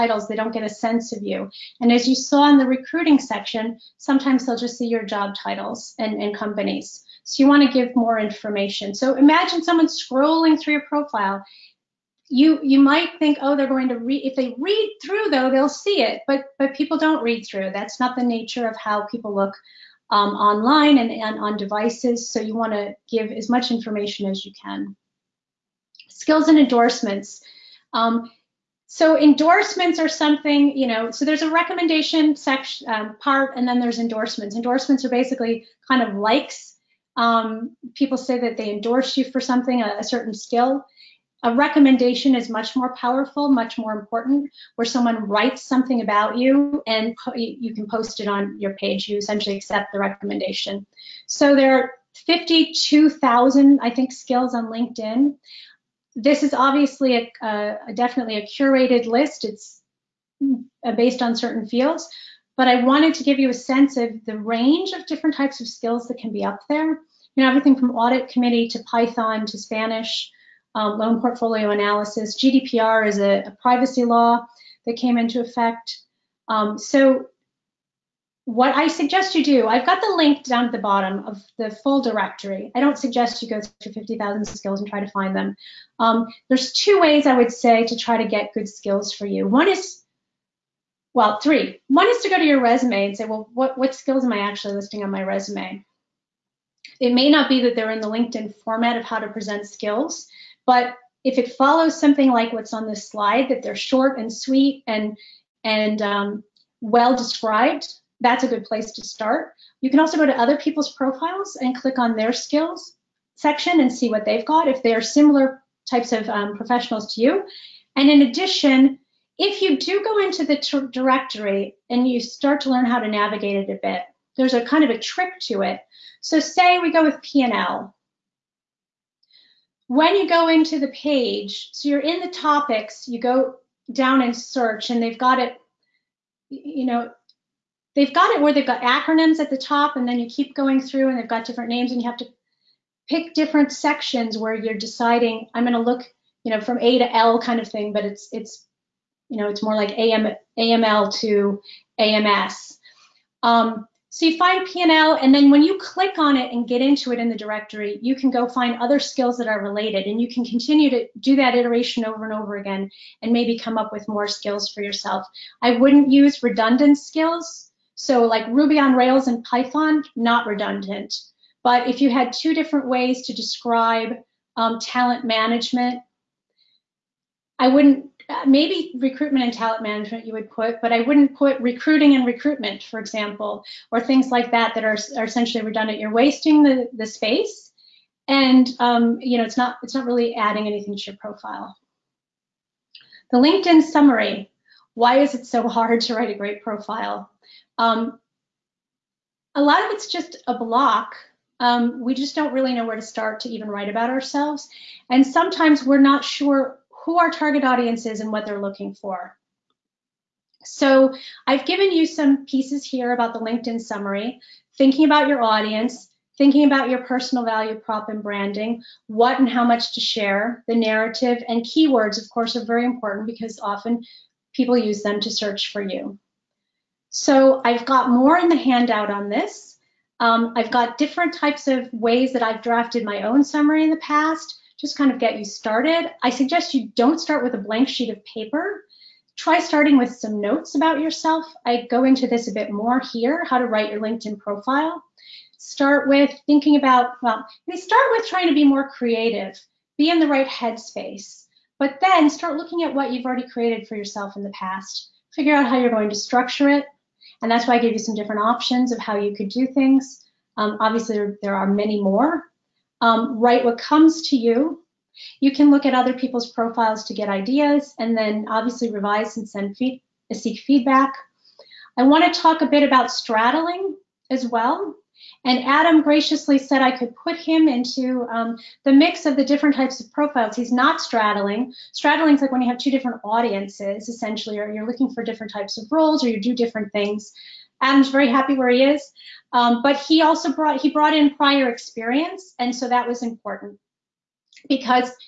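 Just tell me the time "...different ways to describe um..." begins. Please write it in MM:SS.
02:52.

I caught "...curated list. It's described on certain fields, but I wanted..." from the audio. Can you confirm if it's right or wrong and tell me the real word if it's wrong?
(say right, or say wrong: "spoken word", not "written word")
wrong: "based", not "described".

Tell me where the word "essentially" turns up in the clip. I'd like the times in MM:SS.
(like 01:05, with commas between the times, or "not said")
00:49, 03:05, 04:44.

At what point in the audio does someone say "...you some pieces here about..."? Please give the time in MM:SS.
03:31.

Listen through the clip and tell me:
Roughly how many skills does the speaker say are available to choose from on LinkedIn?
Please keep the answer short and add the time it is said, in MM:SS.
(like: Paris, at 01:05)
52,000, at 00:52.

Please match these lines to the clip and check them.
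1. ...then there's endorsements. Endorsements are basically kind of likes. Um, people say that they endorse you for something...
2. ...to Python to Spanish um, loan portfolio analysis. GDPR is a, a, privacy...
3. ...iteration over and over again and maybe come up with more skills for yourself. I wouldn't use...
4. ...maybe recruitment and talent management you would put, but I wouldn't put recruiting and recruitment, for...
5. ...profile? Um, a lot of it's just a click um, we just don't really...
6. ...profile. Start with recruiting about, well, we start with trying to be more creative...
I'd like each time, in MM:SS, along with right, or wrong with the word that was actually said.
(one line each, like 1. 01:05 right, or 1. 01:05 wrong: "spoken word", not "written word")
1. 00:33 right
2. 01:08 right
3. 02:41 right
4. 02:58 right
5. 03:16 wrong: "block", not "click"
6. 04:04 wrong: "thinking", not "recruiting".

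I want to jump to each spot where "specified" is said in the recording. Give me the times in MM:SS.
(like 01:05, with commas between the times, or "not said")
not said.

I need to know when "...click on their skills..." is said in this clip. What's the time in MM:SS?
01:51.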